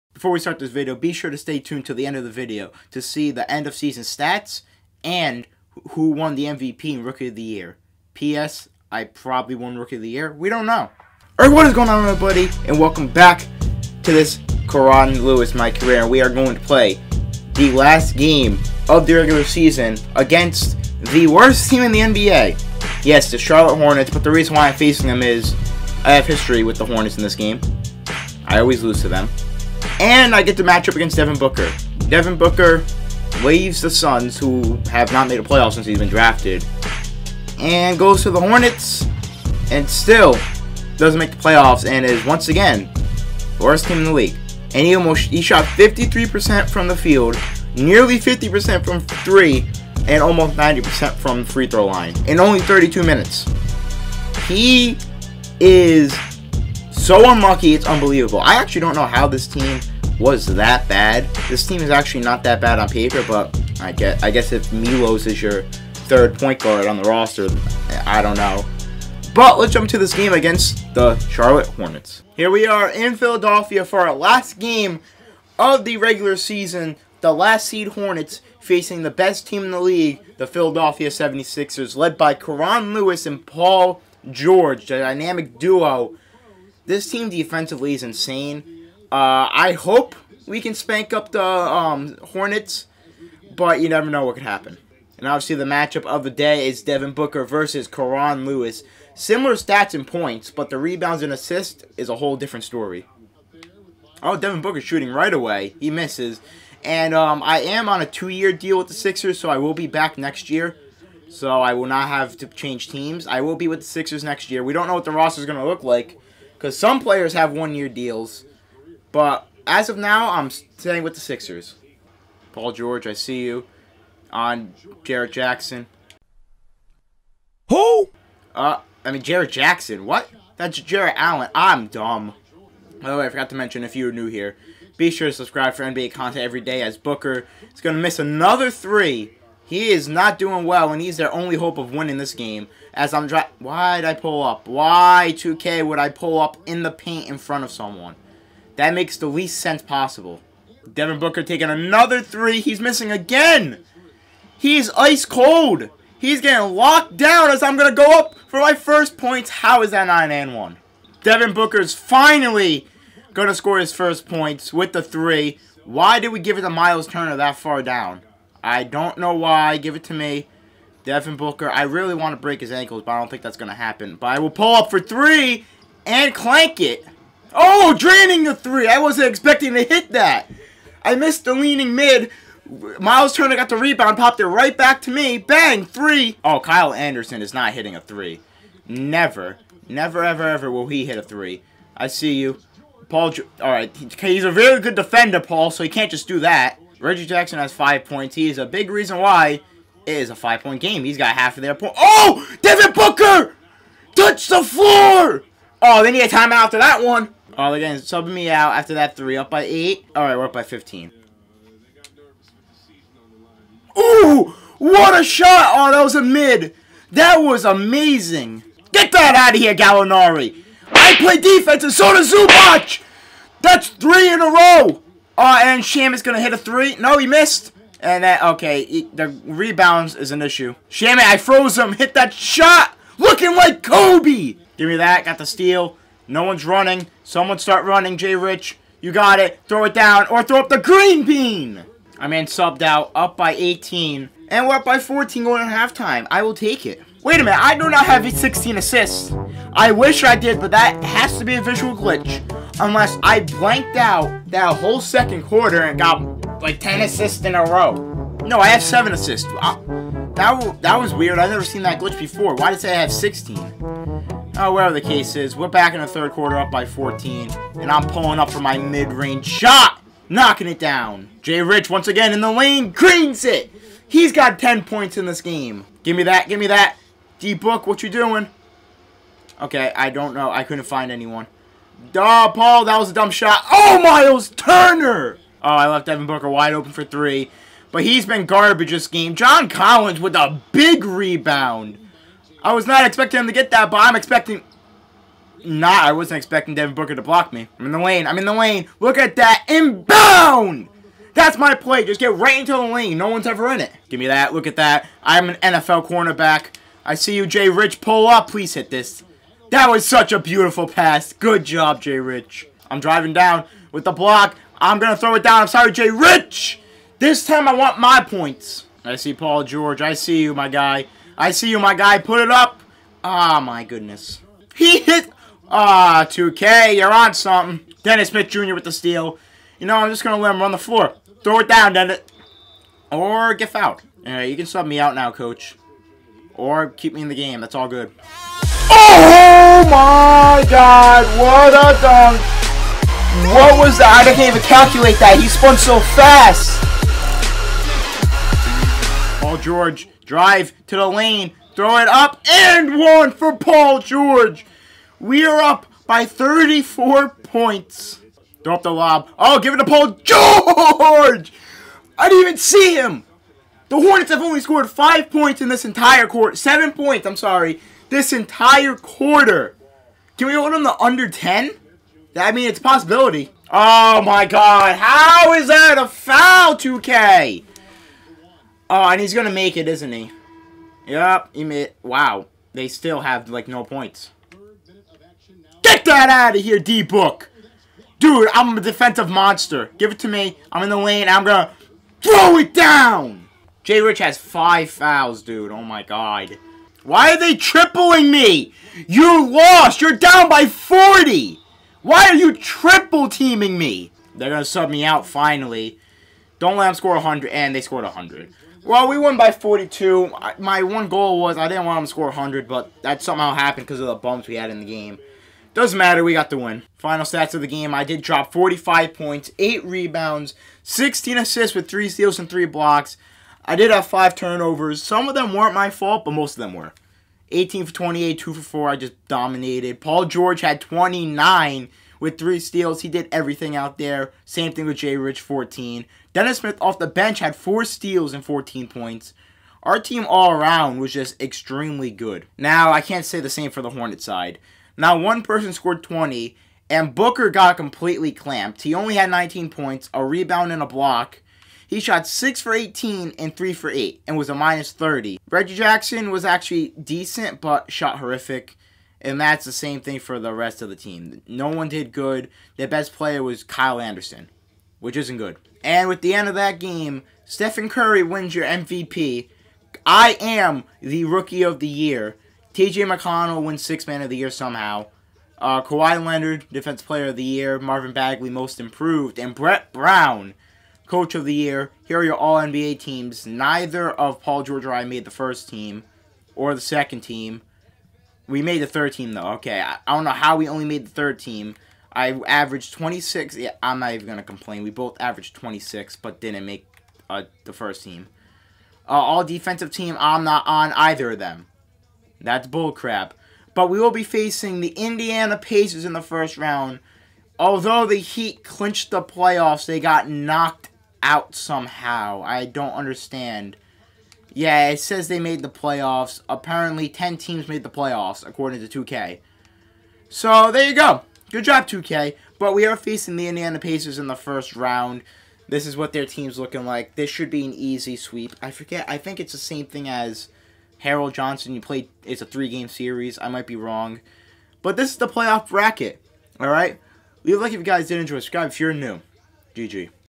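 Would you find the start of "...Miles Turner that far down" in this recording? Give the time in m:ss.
2:46.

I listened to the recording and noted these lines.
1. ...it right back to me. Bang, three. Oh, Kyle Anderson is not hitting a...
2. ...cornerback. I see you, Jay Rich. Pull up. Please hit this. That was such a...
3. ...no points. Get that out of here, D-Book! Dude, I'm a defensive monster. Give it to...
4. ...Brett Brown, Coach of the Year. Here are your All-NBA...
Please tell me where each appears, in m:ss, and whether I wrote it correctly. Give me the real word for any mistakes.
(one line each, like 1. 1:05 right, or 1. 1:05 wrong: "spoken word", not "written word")
1. 3:04 right
2. 5:06 right
3. 6:23 right
4. 7:59 right.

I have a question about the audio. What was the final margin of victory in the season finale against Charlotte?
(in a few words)
42.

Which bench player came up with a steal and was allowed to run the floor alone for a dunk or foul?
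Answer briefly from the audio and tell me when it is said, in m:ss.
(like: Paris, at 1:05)
Dennis Smith Jr., at 5:28.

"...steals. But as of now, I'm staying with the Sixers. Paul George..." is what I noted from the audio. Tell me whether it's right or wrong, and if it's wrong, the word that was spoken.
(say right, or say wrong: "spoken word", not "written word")
wrong: "deals", not "steals".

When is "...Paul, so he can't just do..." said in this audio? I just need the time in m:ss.
3:15.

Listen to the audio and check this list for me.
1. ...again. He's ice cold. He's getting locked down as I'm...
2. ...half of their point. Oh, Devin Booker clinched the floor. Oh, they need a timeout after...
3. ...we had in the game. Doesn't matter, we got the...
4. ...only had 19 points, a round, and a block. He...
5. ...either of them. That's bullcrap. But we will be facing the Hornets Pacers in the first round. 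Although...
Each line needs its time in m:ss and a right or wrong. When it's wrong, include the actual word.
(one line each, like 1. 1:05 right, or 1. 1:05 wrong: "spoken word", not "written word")
1. 2:33 right
2. 3:21 wrong: "touched", not "clinched"
3. 6:54 right
4. 7:28 wrong: "rebound", not "round"
5. 8:20 wrong: "Indiana", not "Hornets".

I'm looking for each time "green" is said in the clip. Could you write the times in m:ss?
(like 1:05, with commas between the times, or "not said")
4:00, 4:32.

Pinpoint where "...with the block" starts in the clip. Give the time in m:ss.
5:13.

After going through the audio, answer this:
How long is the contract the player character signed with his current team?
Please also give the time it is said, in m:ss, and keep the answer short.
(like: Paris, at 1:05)
two-year, at 1:48.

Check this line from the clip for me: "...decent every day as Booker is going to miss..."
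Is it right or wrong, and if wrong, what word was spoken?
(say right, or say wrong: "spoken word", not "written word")
wrong: "content", not "decent".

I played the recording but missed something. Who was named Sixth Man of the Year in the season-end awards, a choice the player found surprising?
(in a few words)
T.J. McConnell.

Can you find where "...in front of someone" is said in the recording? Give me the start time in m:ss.
2:27.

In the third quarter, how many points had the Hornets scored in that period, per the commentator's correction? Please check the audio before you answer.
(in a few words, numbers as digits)
7.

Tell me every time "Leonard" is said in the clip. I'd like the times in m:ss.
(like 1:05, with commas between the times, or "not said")
7:56.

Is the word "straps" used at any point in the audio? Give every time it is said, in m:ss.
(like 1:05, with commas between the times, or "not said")
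not said.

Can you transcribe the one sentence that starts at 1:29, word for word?
Uh, I hope we can spank up the um, Hornets, but you never know what could happen.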